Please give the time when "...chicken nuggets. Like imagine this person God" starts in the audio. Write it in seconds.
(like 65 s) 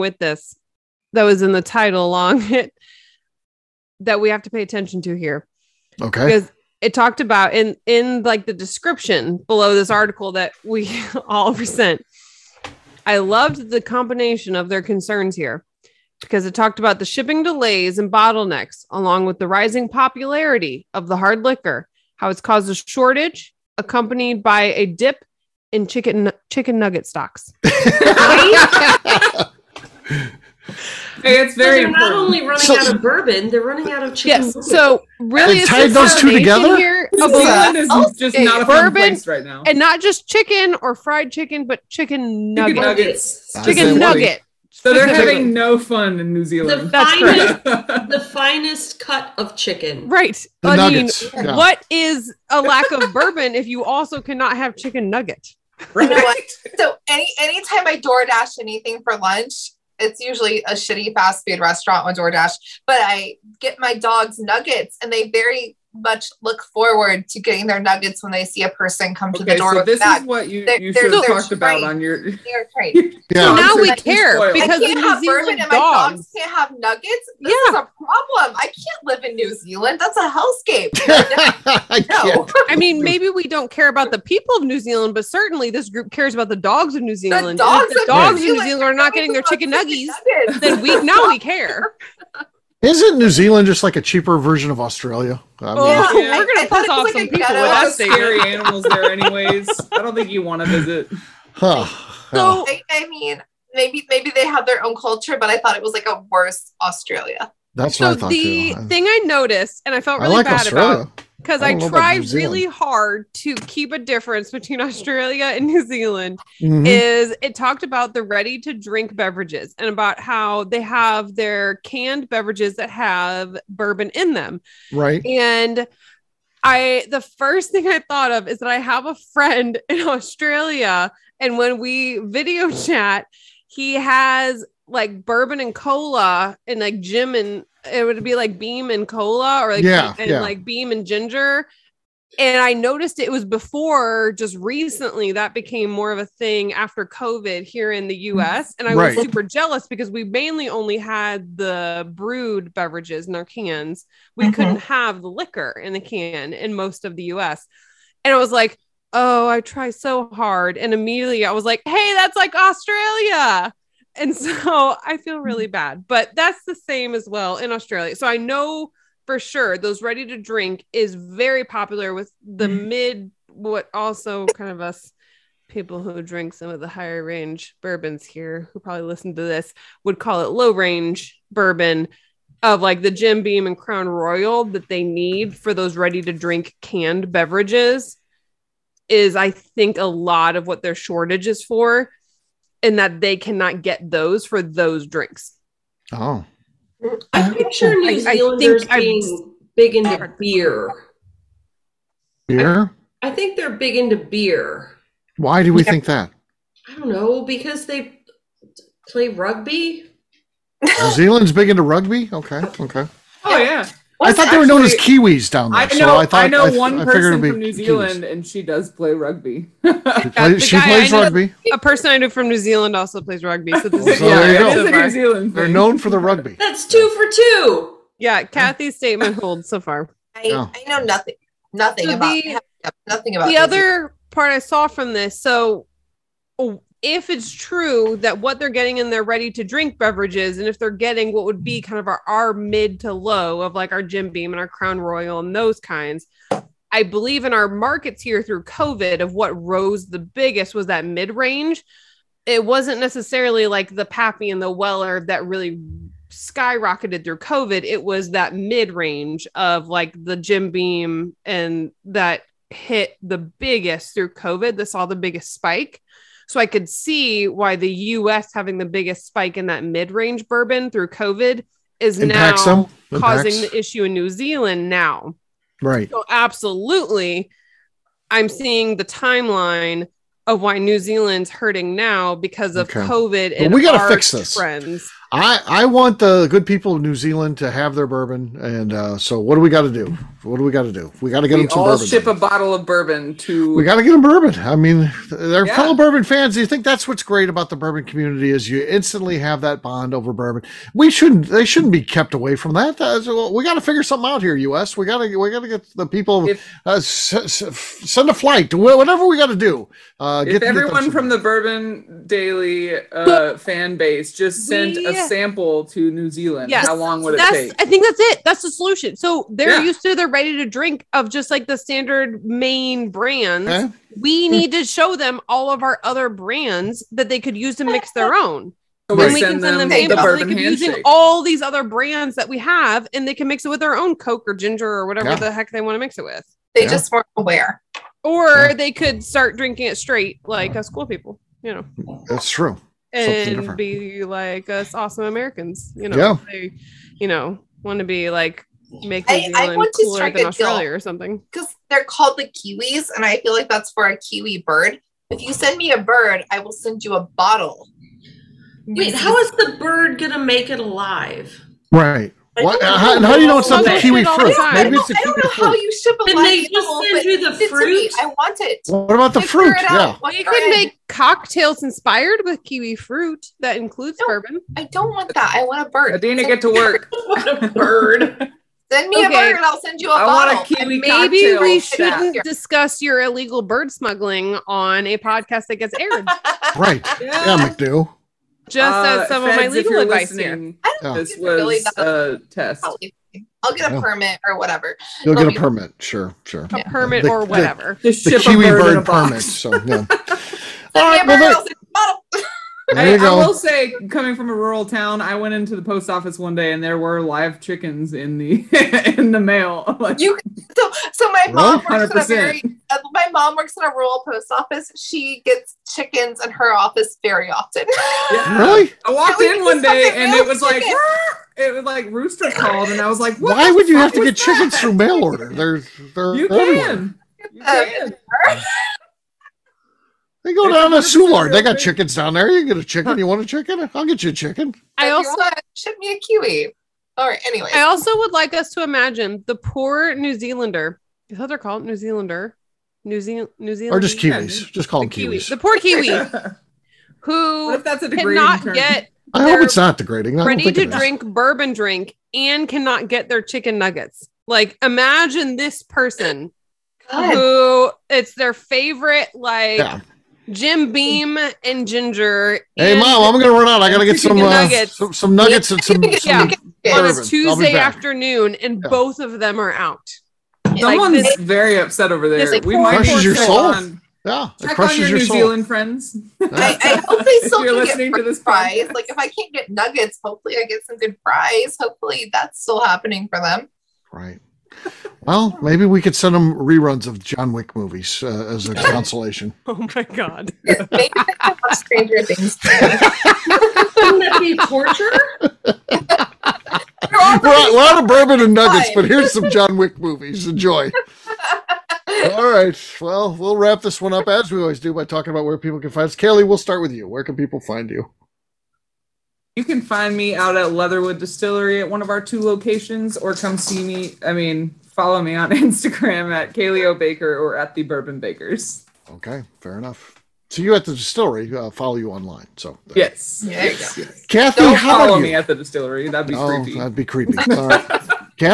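453 s.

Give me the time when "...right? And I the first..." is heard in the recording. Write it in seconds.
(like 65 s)
124 s.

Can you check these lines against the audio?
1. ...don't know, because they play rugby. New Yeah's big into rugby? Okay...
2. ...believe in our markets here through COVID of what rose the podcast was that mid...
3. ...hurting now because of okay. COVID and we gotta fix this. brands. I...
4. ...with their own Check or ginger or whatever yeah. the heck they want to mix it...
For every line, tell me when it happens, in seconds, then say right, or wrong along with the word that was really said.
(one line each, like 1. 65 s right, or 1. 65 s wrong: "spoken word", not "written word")
1. 206 s wrong: "Zealand", not "Yeah"
2. 247 s wrong: "biggest", not "podcast"
3. 281 s wrong: "friends", not "brands"
4. 333 s wrong: "Coke", not "Check".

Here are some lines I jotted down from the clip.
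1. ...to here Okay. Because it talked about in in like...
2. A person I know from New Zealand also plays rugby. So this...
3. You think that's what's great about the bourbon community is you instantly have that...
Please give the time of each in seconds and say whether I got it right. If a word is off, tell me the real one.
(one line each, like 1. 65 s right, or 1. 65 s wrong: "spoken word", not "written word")
1. 5 s right
2. 221 s right
3. 296 s right.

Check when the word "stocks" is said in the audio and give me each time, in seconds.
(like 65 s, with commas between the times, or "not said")
27 s.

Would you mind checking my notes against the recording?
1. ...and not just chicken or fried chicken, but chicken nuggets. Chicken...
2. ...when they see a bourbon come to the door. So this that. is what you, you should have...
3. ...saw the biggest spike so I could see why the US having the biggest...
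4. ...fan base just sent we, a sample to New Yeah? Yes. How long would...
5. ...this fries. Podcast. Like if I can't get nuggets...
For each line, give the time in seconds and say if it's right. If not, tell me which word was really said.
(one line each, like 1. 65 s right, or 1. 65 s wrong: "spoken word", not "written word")
1. 39 s right
2. 68 s wrong: "person", not "bourbon"
3. 264 s right
4. 313 s wrong: "Zealand", not "Yeah"
5. 478 s right.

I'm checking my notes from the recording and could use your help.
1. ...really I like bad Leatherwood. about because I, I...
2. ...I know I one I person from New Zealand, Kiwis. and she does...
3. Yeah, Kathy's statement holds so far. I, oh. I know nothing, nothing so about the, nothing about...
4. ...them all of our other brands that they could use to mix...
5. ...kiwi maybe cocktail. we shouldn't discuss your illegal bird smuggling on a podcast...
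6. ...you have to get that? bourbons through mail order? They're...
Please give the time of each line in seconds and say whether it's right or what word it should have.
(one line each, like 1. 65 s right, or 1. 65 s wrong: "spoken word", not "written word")
1. 110 s wrong: "Australia", not "Leatherwood"
2. 216 s right
3. 228 s right
4. 325 s right
5. 380 s right
6. 423 s wrong: "chickens", not "bourbons".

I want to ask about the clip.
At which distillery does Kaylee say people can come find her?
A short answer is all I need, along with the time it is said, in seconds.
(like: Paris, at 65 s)
Leatherwood Distillery, at 510 s.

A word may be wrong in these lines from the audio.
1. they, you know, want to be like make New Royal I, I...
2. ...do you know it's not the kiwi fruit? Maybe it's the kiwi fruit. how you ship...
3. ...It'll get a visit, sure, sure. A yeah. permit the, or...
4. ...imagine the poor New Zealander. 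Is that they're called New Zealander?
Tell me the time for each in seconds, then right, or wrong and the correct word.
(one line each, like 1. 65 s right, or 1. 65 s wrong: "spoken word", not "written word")
1. 346 s wrong: "Zealand", not "Royal"
2. 363 s right
3. 395 s wrong: "permit", not "visit"
4. 438 s right.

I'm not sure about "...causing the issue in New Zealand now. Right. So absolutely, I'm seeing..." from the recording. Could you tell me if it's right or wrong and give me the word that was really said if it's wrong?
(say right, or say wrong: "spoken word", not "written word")
right.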